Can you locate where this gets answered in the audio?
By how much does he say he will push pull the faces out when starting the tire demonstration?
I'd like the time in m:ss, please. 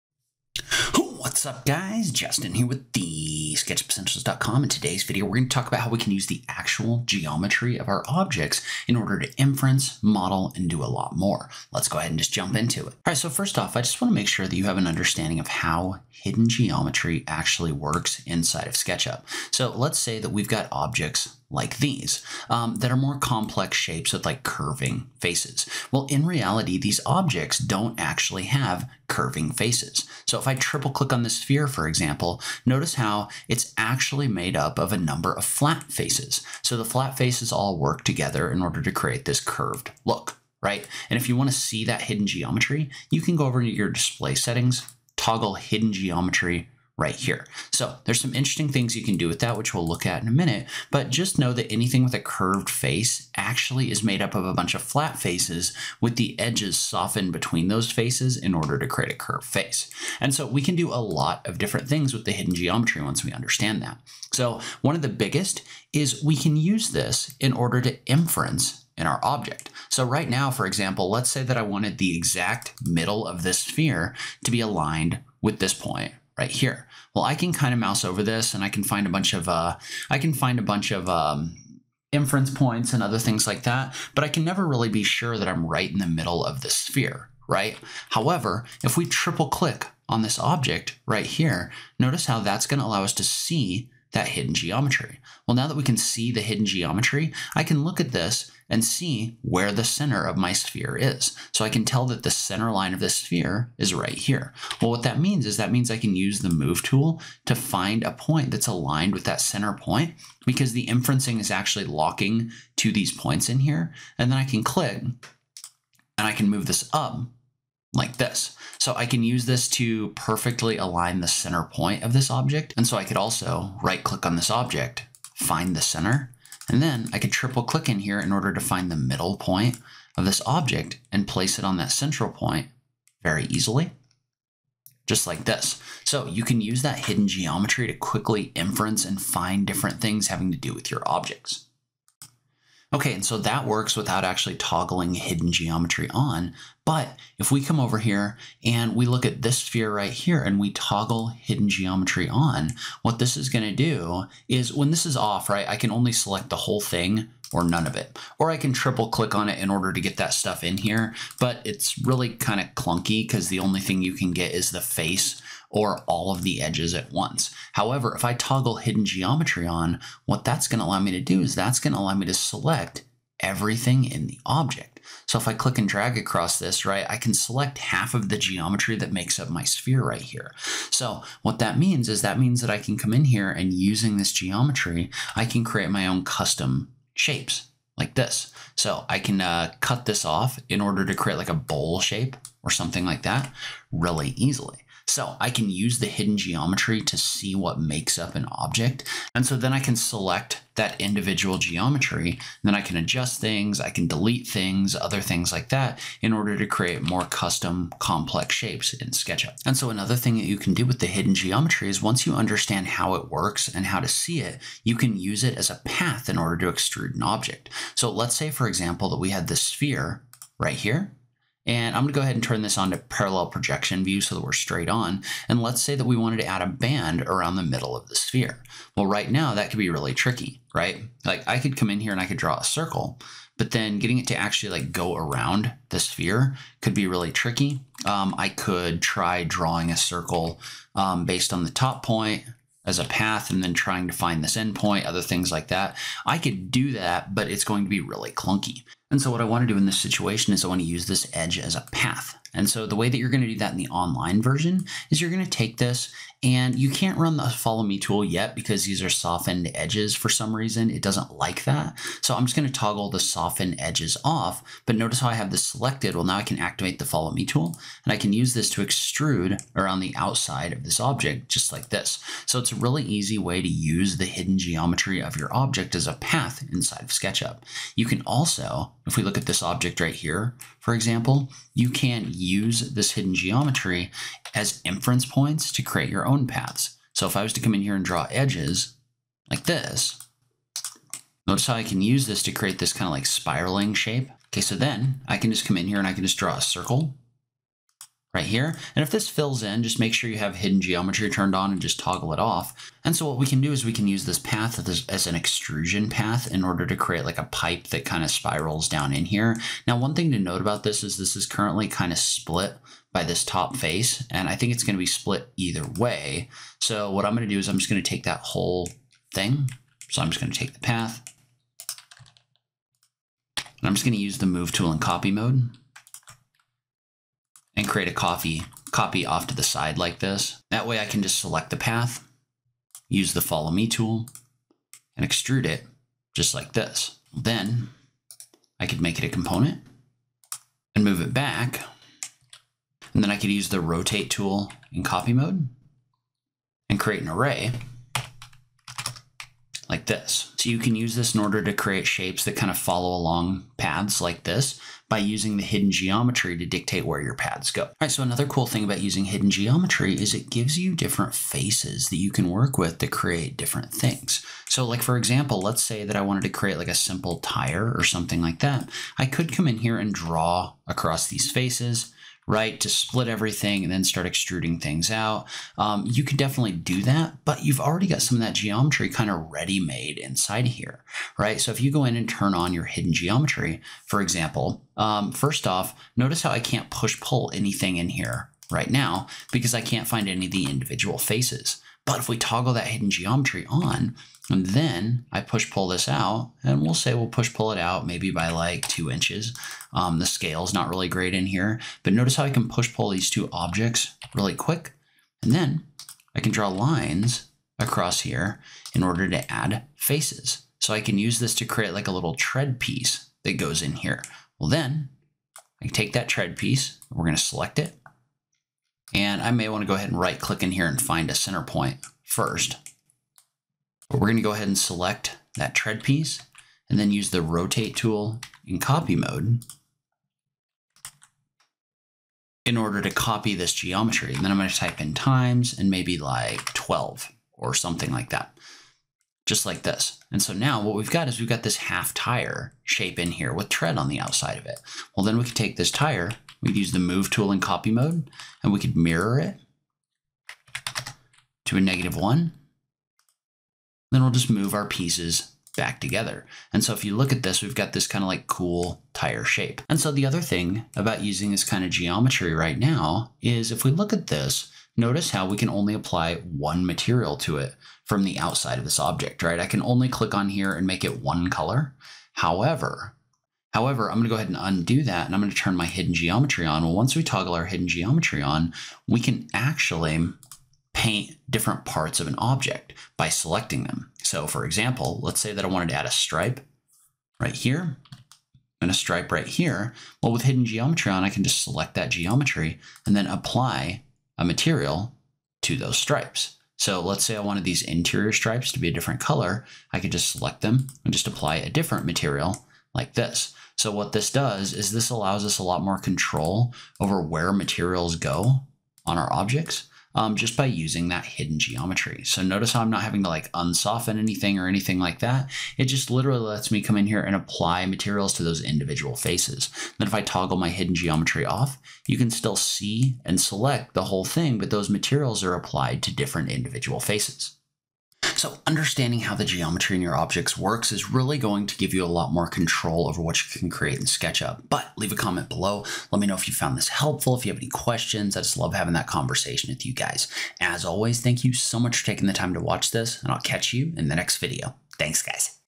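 6:38.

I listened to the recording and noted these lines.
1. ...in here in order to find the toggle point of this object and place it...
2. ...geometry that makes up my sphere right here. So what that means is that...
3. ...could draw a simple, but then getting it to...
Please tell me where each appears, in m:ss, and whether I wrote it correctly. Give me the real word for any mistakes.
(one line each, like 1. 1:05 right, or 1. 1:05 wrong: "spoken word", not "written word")
1. 2:07 wrong: "middle", not "toggle"
2. 2:58 right
3. 3:52 wrong: "circle", not "simple".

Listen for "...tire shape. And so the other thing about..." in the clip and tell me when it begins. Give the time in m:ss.
7:39.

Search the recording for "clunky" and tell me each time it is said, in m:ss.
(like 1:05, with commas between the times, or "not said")
2:42, 4:08.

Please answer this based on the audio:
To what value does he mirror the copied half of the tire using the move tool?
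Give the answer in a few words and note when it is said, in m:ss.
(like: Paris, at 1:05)
negative one, at 7:31.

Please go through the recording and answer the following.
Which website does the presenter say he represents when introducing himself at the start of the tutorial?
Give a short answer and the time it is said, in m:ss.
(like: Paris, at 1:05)
SketchUpEssentials.com, at 0:03.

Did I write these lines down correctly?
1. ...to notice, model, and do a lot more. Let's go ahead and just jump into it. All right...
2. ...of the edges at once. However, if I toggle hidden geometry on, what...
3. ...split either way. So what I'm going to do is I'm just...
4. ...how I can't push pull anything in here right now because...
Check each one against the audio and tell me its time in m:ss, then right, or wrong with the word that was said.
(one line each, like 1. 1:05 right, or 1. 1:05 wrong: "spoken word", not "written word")
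1. 0:09 wrong: "inference", not "notice"
2. 2:46 right
3. 5:15 right
4. 6:26 right.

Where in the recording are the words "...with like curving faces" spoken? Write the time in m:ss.
0:24.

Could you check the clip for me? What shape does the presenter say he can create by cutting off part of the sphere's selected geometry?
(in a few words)
a bowl.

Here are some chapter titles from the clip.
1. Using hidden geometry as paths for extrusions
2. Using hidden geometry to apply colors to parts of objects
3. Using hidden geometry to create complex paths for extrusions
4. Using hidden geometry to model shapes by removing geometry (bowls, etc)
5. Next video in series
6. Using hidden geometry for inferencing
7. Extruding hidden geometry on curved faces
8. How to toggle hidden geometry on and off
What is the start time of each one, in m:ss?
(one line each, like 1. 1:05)
1. 3:49
2. 7:44
3. 4:39
4. 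2:30
5. 8:48
6. 0:12
7. 5:58
8. 0:44.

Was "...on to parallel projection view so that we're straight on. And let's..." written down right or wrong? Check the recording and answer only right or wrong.
right.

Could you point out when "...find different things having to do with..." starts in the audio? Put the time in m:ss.
2:19.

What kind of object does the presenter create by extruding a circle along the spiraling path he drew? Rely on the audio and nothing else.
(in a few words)
a pipe.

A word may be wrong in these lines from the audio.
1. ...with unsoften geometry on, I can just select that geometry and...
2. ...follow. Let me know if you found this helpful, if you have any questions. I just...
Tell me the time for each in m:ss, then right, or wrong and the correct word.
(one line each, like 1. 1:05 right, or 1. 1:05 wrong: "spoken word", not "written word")
1. 8:10 wrong: "hidden", not "unsoften"
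2. 8:55 wrong: "below", not "follow".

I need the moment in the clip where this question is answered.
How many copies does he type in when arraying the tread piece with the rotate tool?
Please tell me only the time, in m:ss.
7:16.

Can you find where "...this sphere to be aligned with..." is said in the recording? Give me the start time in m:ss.
1:13.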